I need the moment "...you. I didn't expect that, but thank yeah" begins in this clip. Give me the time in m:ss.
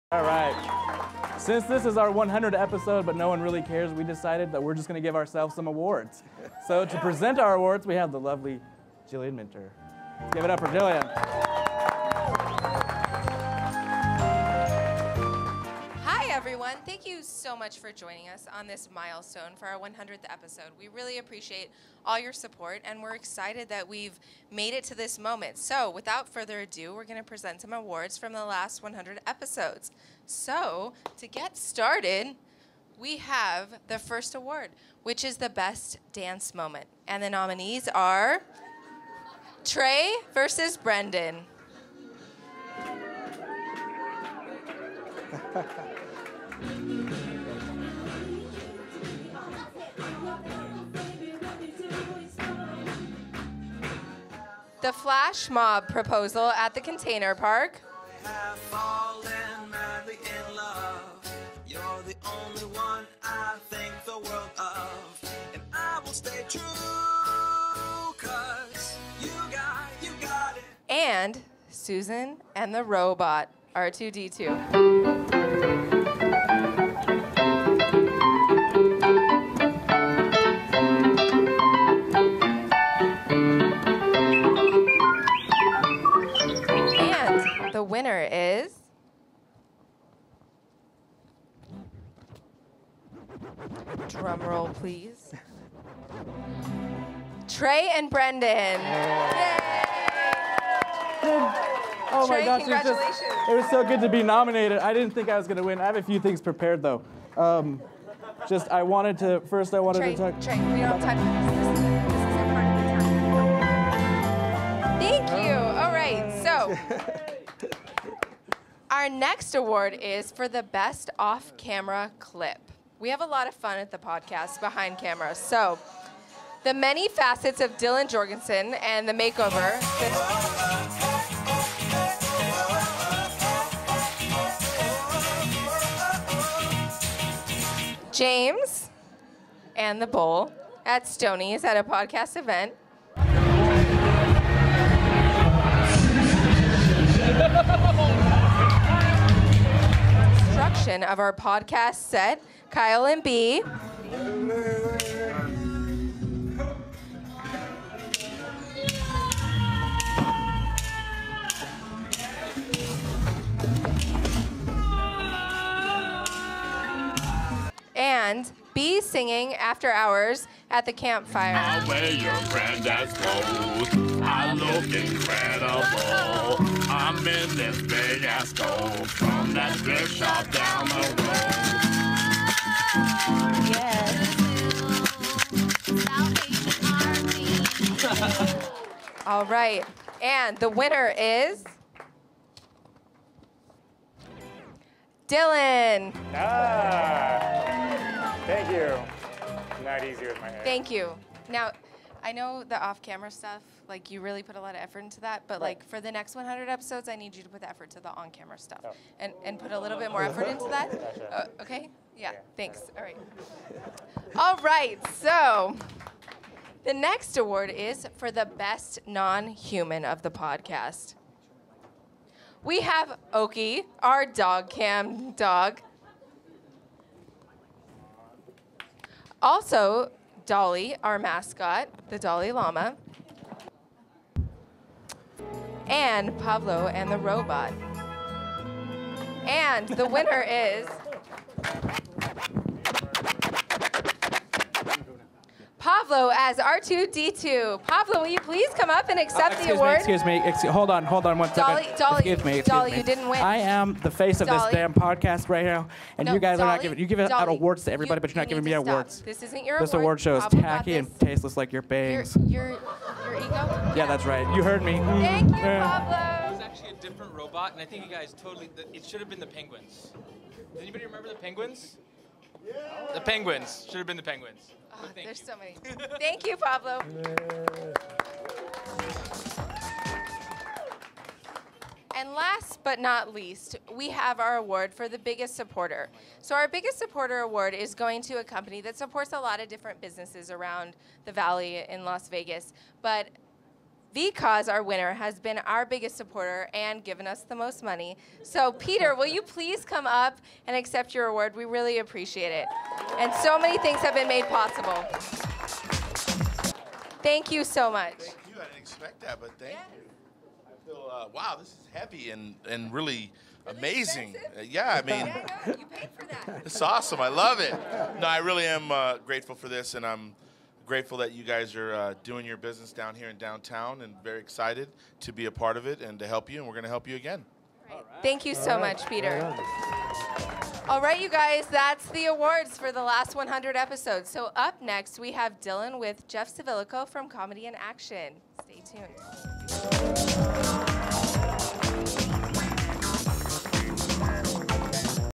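5:08.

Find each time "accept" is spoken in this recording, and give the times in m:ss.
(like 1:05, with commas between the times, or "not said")
4:09, 5:00.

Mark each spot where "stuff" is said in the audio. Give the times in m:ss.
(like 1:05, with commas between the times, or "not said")
3:23, 3:28.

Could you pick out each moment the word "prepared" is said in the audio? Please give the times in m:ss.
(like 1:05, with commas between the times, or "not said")
1:46.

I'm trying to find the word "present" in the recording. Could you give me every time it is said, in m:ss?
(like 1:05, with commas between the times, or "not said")
0:06, 0:27.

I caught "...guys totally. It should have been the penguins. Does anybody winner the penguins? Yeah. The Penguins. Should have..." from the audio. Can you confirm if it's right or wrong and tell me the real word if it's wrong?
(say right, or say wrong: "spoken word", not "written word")
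wrong: "remember", not "winner".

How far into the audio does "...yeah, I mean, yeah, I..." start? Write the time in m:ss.
5:14.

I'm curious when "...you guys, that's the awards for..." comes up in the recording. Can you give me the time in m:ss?
5:31.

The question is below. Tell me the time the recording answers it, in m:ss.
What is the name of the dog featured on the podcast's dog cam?
3:43.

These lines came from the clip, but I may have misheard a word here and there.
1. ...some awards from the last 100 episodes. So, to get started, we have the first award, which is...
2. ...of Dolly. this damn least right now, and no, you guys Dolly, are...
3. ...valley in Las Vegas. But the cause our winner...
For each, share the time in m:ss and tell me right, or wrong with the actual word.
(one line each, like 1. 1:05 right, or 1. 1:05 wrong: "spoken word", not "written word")
1. 0:27 right
2. 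4:14 wrong: "podcast", not "least"
3. 4:51 right.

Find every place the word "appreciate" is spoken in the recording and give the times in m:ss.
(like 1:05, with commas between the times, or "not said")
0:21, 5:01.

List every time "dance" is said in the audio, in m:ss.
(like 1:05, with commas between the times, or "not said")
0:36.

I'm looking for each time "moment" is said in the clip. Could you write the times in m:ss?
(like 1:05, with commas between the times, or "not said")
0:25, 0:36.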